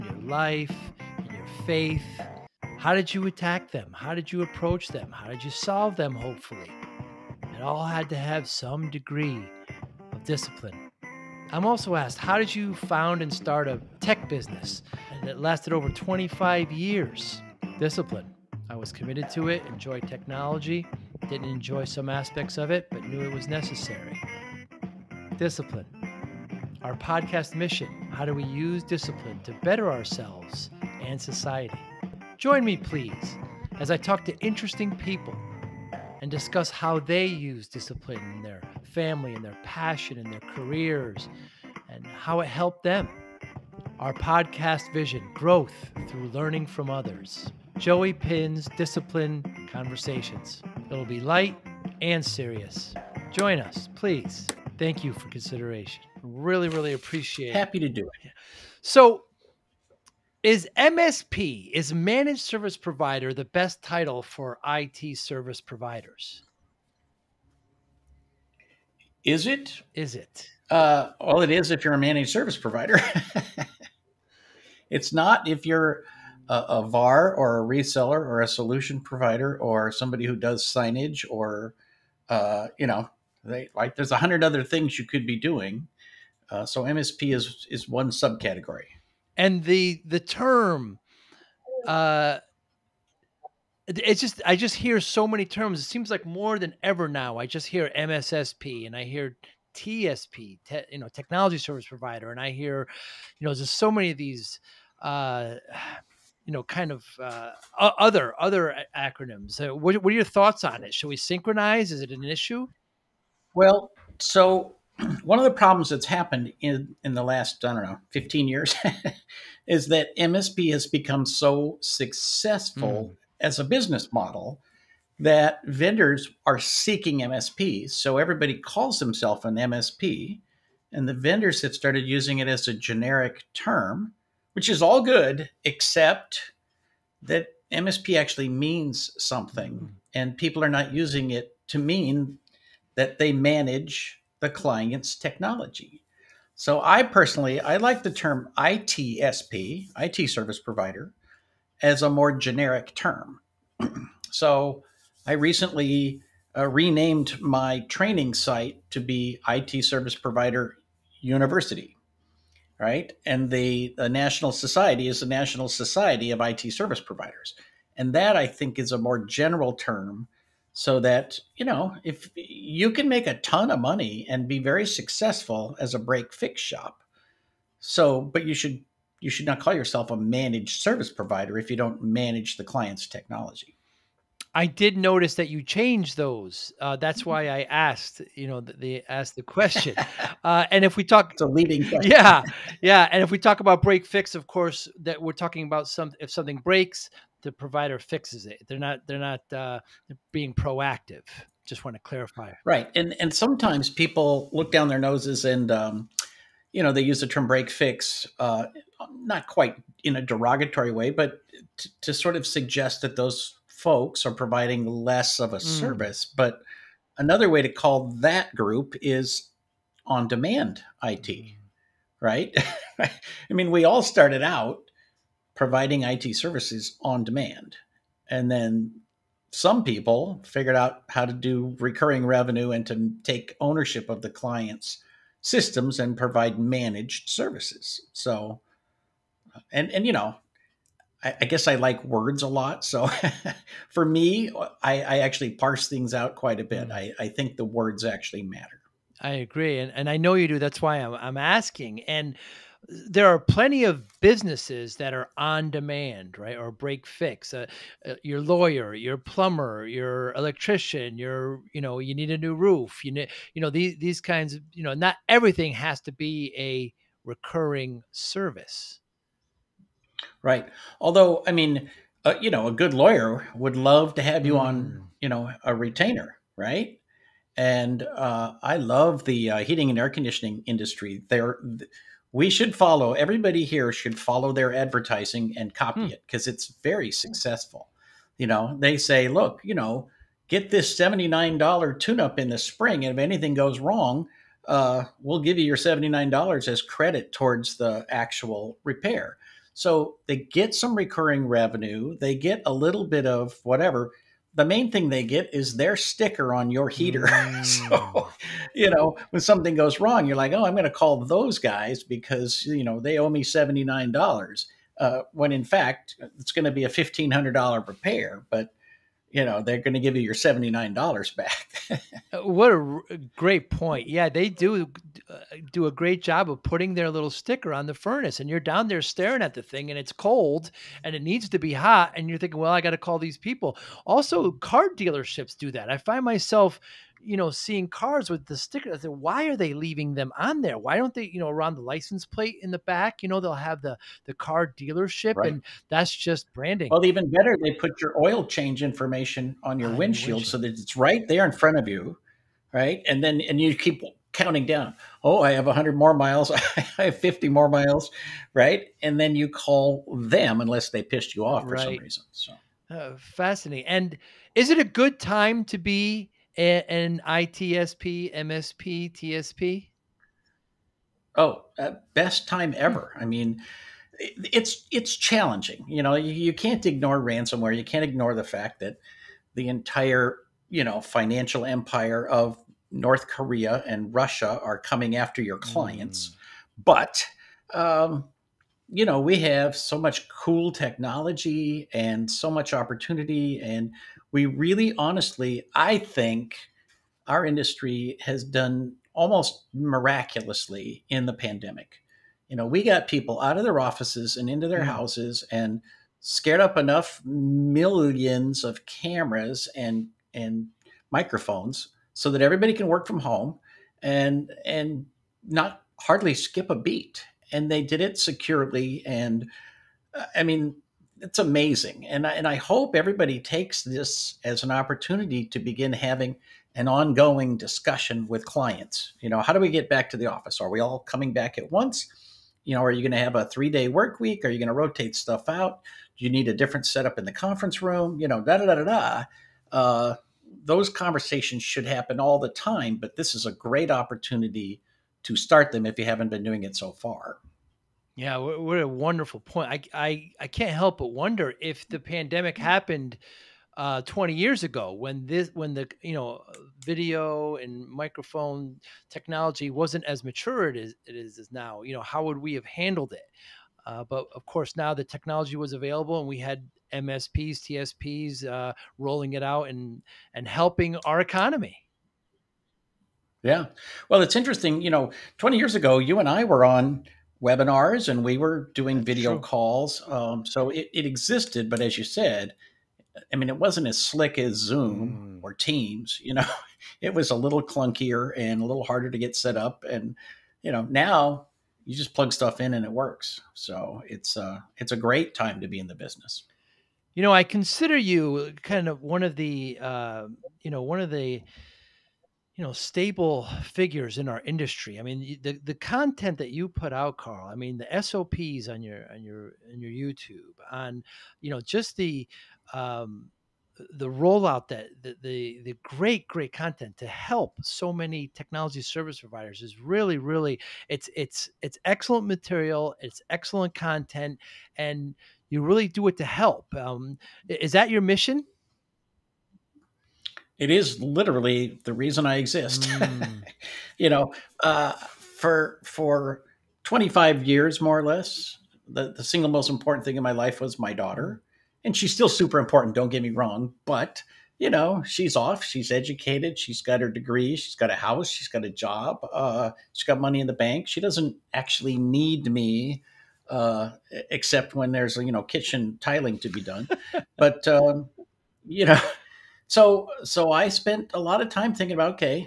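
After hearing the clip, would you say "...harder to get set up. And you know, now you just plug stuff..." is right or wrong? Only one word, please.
right.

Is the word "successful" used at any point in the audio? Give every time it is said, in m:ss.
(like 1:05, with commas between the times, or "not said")
2:01, 2:54, 4:47.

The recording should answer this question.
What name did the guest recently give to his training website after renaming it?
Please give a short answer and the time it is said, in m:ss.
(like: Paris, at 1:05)
IT Service Provider University, at 2:39.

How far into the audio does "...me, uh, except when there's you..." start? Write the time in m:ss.
9:12.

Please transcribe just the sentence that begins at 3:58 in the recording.
So, and, and you know, I, I guess I like words a lot.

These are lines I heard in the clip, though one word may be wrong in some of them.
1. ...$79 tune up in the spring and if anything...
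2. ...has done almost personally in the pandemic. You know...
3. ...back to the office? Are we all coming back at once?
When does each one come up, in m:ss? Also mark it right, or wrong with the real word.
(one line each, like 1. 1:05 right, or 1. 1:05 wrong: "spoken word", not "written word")
1. 4:50 right
2. 6:38 wrong: "miraculously", not "personally"
3. 7:09 right.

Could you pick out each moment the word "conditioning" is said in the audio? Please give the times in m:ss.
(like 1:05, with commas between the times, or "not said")
4:40.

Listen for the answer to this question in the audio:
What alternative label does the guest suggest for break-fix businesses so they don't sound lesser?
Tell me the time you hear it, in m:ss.
3:40.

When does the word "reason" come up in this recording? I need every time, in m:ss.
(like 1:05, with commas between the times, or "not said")
6:01, 8:51.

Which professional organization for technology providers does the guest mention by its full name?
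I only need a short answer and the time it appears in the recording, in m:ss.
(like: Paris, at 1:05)
National Society of IT Service Providers, at 2:45.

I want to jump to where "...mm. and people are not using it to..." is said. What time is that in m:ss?
2:19.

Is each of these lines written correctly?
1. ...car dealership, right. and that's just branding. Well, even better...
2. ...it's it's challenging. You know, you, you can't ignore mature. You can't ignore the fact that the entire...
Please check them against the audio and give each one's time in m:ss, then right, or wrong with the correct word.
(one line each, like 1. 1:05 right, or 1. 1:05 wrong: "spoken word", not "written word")
1. 5:44 right
2. 6:14 wrong: "ransomware", not "mature".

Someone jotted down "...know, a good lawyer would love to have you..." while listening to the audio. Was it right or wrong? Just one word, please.
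right.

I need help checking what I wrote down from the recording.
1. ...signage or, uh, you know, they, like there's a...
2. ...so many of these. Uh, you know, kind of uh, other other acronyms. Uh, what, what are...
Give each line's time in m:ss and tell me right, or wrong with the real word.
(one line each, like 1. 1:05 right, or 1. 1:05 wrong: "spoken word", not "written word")
1. 1:20 right
2. 1:43 right.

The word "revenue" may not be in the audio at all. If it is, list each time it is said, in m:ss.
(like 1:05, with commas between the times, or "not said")
3:52, 5:01.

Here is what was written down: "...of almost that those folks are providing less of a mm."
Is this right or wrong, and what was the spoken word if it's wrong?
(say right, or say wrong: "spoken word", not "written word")
wrong: "suggest", not "almost".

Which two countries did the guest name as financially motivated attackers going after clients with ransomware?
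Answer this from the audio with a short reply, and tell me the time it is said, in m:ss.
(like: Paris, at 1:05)
North Korea and Russia, at 6:22.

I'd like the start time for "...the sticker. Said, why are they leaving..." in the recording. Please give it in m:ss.
5:38.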